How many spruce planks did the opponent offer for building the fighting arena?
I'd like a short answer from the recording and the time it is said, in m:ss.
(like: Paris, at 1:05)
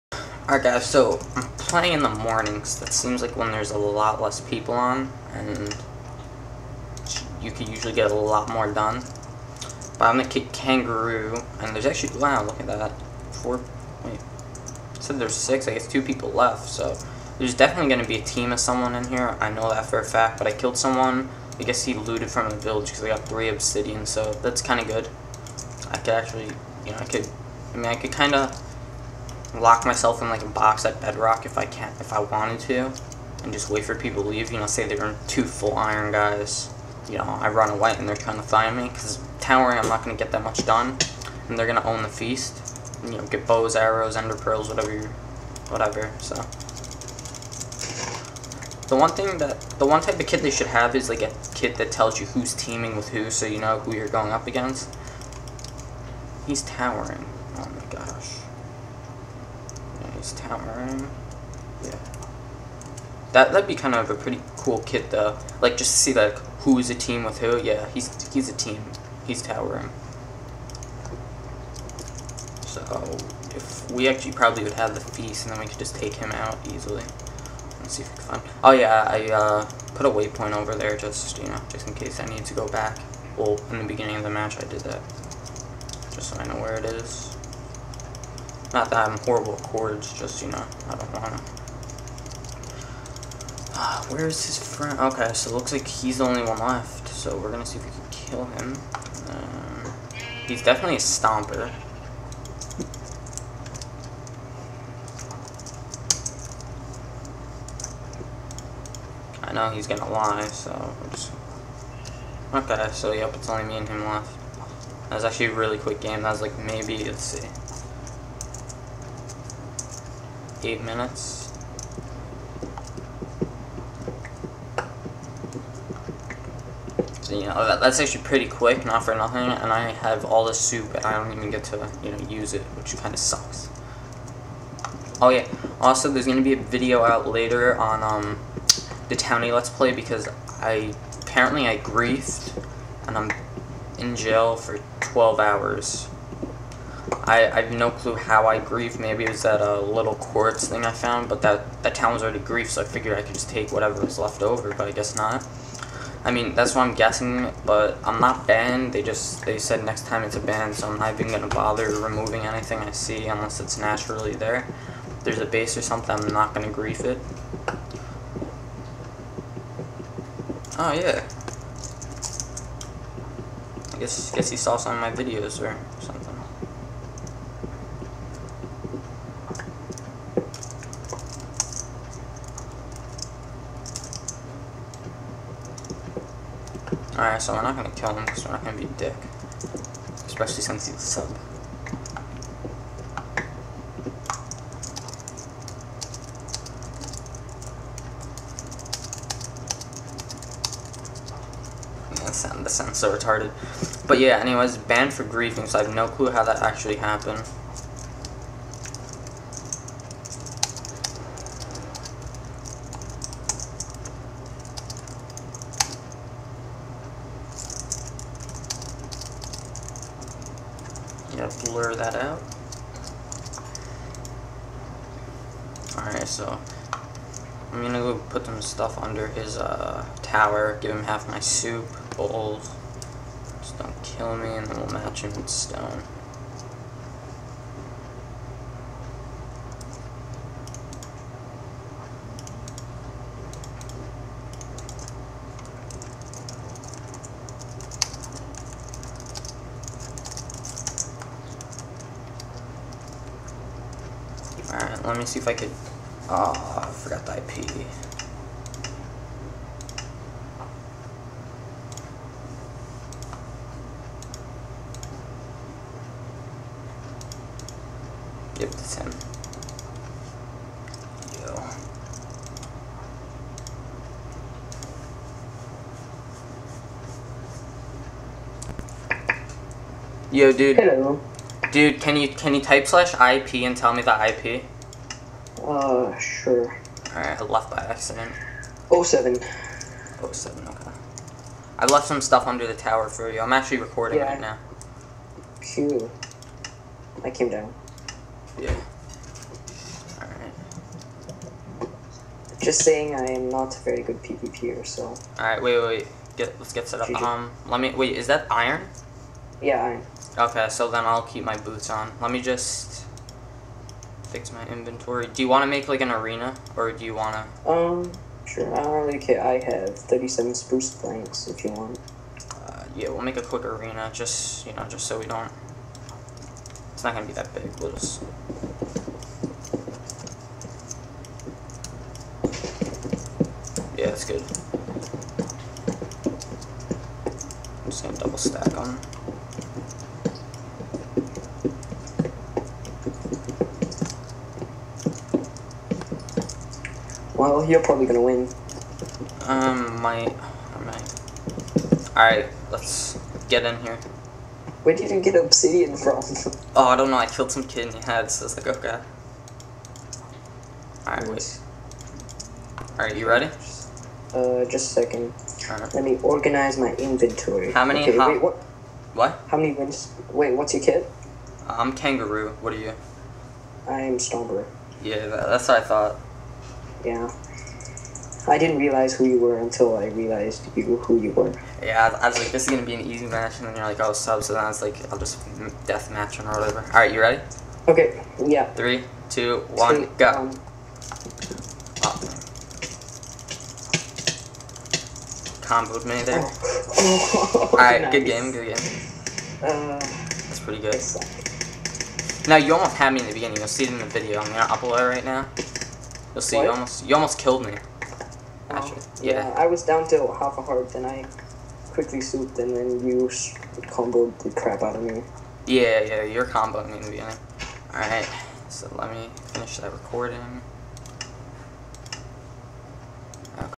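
37, at 5:19.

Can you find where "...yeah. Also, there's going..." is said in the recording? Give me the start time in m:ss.
2:15.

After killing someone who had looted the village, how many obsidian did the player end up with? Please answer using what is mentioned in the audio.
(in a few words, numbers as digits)
3.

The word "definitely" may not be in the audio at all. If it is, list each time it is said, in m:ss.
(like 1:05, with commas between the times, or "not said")
0:17, 1:40.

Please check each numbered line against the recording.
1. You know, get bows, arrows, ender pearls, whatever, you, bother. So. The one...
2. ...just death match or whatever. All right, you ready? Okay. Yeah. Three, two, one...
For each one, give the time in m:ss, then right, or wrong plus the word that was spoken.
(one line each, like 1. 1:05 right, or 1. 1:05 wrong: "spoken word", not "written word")
1. 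0:43 wrong: "whatever", not "bother"
2. 6:25 right.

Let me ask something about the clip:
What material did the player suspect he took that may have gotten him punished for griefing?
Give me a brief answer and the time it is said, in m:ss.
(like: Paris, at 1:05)
quartz, at 2:30.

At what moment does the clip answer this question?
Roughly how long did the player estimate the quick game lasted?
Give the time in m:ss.
2:00.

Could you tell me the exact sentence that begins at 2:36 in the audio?
I mean, that's what I'm guessing, but I'm not banned.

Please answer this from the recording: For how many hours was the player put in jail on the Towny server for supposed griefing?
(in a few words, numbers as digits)
12.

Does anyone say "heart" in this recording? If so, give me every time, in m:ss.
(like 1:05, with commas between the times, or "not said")
6:50.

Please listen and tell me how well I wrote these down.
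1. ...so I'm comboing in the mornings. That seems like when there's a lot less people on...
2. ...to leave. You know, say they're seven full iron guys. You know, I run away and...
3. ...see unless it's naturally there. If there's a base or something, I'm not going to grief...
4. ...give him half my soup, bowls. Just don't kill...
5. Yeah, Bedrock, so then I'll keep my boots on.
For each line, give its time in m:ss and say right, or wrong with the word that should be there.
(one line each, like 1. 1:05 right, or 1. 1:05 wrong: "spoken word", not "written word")
1. 0:00 wrong: "playing", not "comboing"
2. 0:34 wrong: "two", not "seven"
3. 2:42 right
4. 3:50 right
5. 5:09 wrong: "Okay", not "Bedrock".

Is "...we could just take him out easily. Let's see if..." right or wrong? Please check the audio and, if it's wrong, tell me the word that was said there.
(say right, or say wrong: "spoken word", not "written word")
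right.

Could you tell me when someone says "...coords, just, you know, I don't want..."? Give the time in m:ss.
1:29.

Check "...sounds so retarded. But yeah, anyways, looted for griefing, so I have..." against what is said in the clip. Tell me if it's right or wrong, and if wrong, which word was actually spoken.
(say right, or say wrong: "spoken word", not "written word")
wrong: "banned", not "looted".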